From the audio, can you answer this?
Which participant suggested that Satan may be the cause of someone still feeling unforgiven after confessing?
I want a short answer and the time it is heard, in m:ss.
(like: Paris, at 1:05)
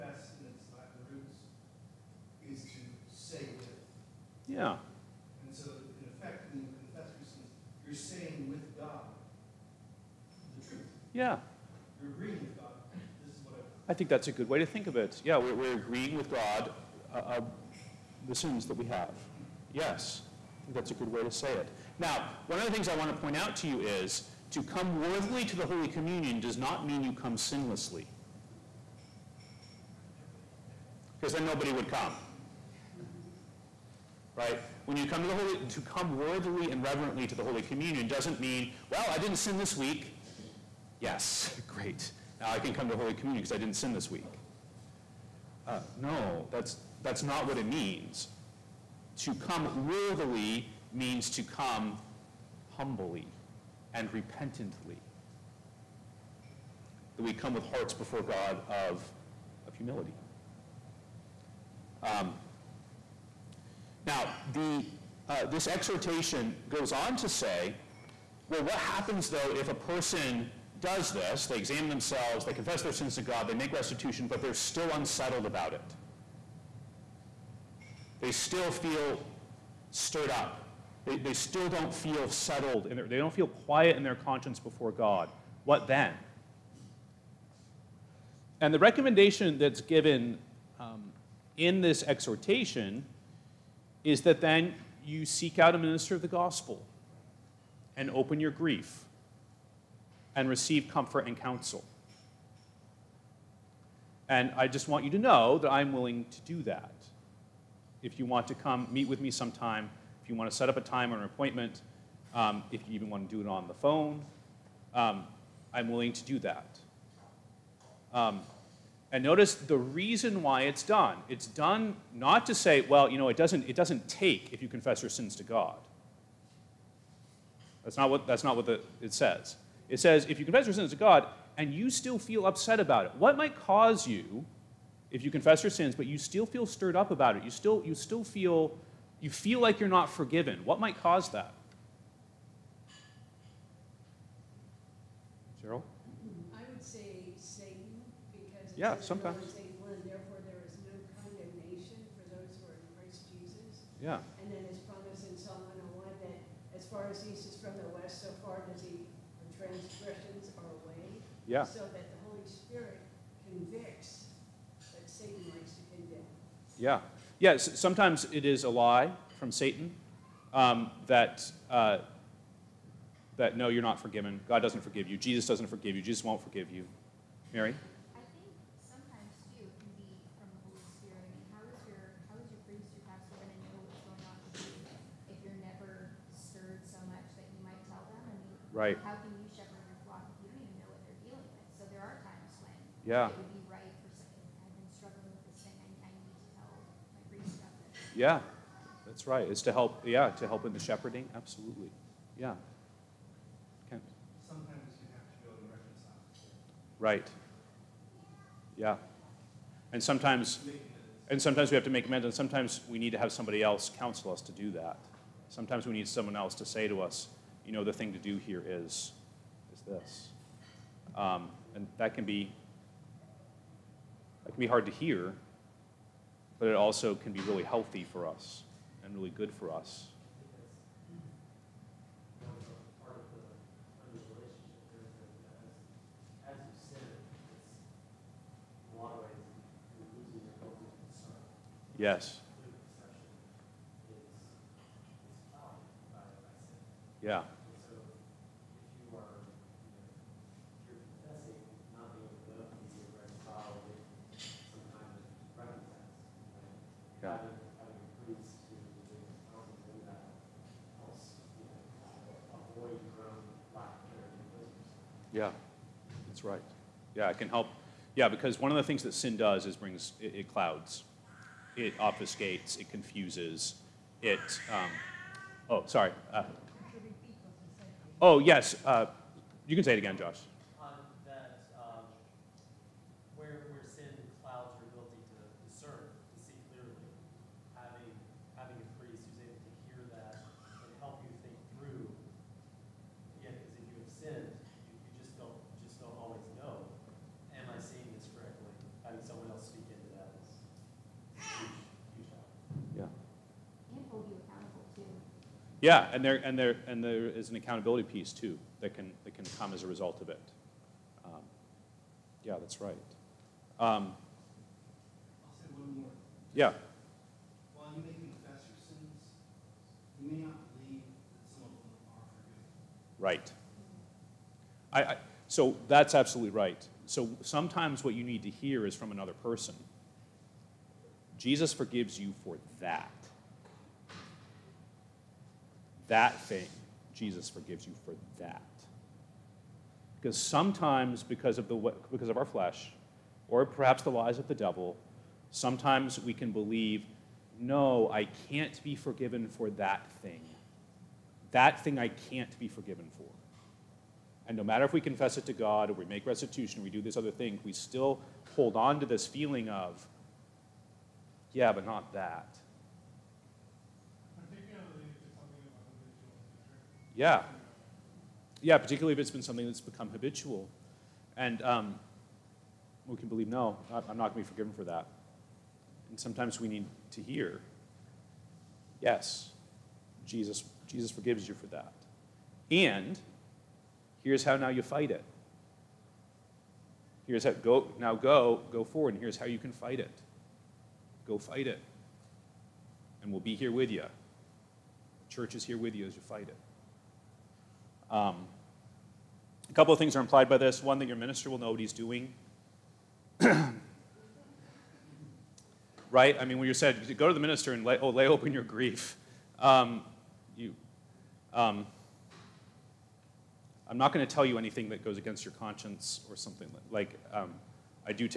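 Cheryl, at 2:25.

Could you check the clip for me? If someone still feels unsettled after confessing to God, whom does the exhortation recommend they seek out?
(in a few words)
A minister of the gospel.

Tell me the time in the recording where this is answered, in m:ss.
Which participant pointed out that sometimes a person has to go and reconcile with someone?
3:23.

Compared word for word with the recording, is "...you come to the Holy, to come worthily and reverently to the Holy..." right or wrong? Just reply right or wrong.
right.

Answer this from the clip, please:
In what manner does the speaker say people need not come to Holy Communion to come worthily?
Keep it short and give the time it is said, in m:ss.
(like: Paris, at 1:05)
Sinlessly, at 0:27.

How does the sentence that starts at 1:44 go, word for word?
And I just want you to know that I'm willing to do that.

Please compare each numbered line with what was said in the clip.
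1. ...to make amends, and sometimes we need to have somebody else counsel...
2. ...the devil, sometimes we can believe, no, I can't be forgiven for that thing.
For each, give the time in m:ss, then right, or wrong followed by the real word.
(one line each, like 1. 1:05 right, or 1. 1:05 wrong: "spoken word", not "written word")
1. 3:31 right
2. 5:44 right.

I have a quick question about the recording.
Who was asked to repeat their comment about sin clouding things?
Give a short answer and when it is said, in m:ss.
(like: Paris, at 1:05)
Josh, at 4:40.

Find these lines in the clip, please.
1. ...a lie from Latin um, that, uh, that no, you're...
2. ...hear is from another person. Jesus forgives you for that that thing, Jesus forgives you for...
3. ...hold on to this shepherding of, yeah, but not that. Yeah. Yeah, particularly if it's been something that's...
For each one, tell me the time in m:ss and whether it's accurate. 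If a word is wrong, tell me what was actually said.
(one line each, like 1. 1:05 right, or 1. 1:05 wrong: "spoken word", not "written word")
1. 2:48 wrong: "Satan", not "Latin"
2. 5:28 right
3. 5:58 wrong: "feeling", not "shepherding".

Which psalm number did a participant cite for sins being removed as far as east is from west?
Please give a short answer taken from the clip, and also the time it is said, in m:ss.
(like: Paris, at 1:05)
101, at 2:35.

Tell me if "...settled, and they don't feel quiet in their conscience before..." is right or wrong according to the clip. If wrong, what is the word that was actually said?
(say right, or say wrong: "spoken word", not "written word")
right.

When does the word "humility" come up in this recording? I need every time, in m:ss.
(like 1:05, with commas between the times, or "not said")
0:59.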